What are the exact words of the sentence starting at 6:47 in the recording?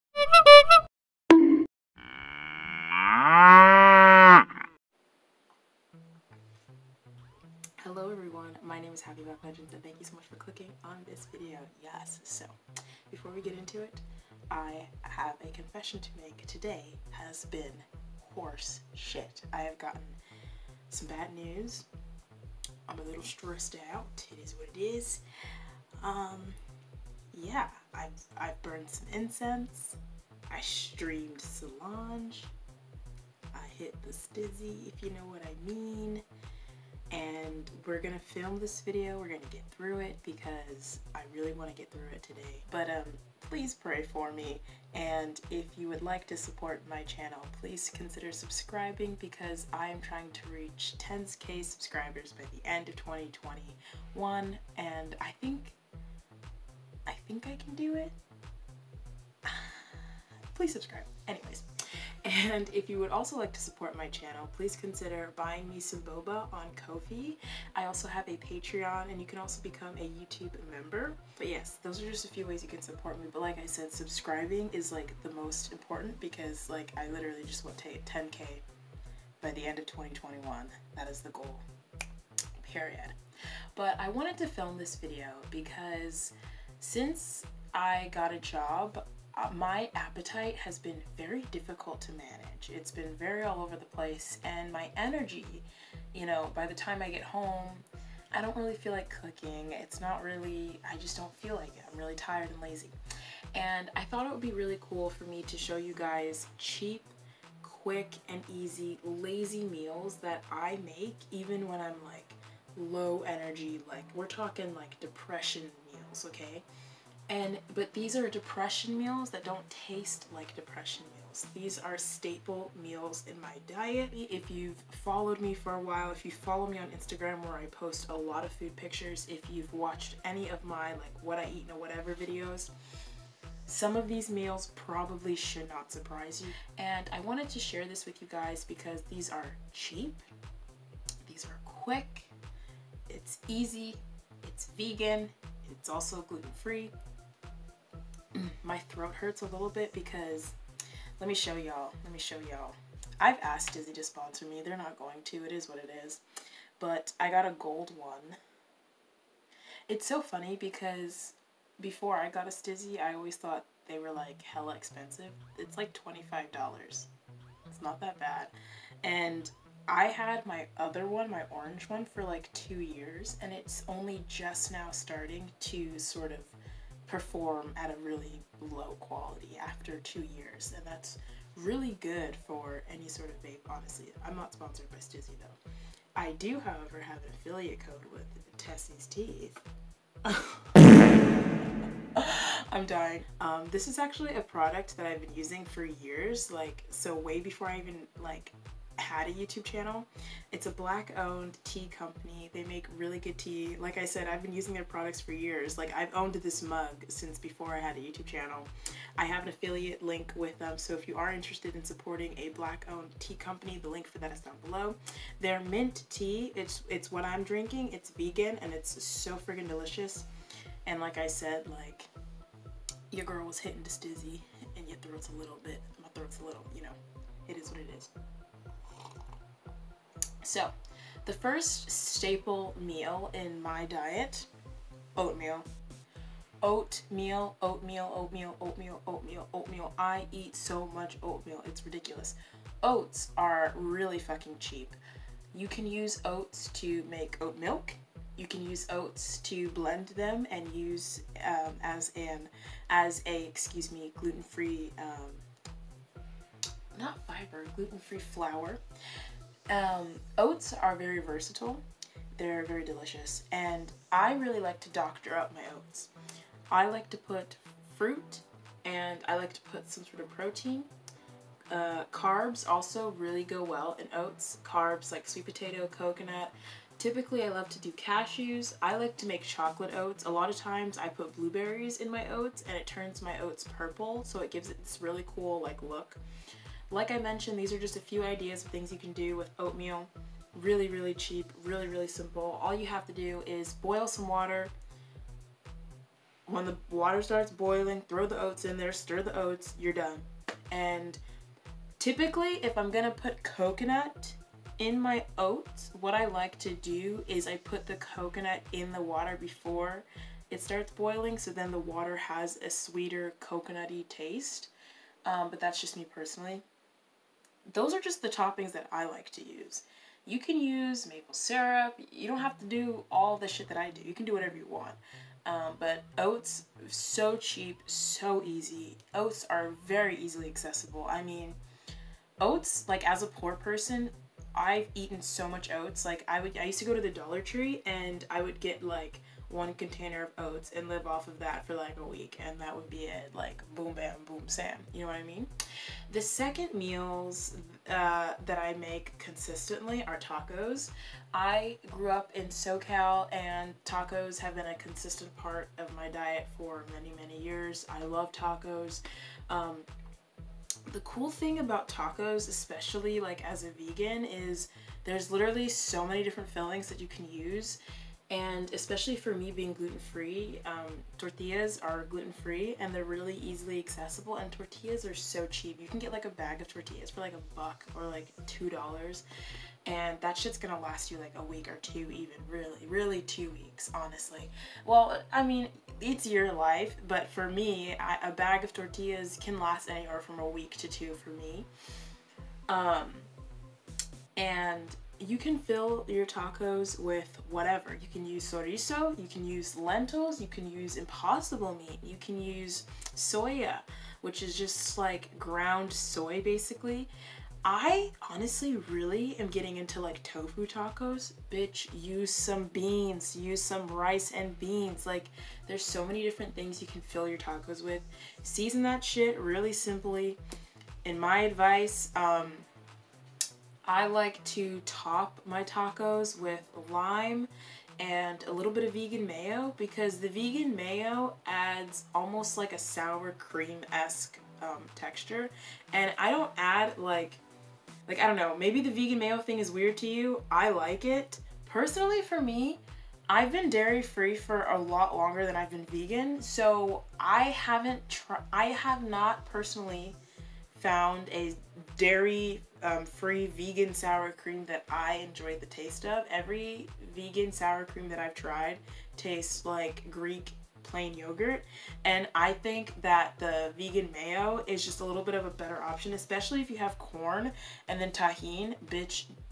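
I honestly really am getting into like tofu tacos.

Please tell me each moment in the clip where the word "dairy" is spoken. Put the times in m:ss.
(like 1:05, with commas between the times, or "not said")
7:23, 7:31.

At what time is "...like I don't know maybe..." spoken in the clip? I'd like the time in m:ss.
7:18.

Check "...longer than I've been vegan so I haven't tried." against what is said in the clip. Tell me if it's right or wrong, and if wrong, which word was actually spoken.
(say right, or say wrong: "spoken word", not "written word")
right.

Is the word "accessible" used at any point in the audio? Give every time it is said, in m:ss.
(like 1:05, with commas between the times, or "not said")
5:30, 6:13.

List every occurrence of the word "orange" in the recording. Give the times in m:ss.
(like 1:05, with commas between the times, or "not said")
2:51.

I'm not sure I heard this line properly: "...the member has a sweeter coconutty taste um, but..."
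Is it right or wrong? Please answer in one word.
wrong.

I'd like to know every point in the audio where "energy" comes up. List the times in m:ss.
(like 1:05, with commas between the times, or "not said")
1:34, 1:53.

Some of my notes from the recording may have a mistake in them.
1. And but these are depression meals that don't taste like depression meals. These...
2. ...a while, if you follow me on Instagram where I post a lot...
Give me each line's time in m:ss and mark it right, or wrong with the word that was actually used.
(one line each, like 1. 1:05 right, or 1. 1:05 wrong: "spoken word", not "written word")
1. 1:57 right
2. 2:05 right.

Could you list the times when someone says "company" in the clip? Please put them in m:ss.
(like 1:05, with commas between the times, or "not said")
3:21, 3:33.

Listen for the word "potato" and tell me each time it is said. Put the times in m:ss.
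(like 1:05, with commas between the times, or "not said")
4:35.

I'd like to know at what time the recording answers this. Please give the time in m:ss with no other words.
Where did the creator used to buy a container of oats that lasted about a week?
5:37.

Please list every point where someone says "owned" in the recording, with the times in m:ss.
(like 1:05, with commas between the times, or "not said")
3:21, 3:26, 3:32.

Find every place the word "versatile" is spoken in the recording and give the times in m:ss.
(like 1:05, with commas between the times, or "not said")
4:21.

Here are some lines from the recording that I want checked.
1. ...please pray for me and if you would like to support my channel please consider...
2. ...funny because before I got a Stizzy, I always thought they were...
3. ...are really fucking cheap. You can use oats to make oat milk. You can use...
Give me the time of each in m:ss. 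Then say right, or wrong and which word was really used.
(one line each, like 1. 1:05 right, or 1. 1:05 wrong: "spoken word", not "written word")
1. 0:43 right
2. 2:40 right
3. 4:03 right.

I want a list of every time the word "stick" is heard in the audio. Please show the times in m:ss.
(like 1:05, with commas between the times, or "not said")
not said.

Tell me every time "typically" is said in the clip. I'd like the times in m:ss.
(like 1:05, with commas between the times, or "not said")
4:36, 5:01.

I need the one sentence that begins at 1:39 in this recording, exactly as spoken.
It's not really, I just don't feel like it.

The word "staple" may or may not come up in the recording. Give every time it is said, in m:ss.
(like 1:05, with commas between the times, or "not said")
2:01, 3:51.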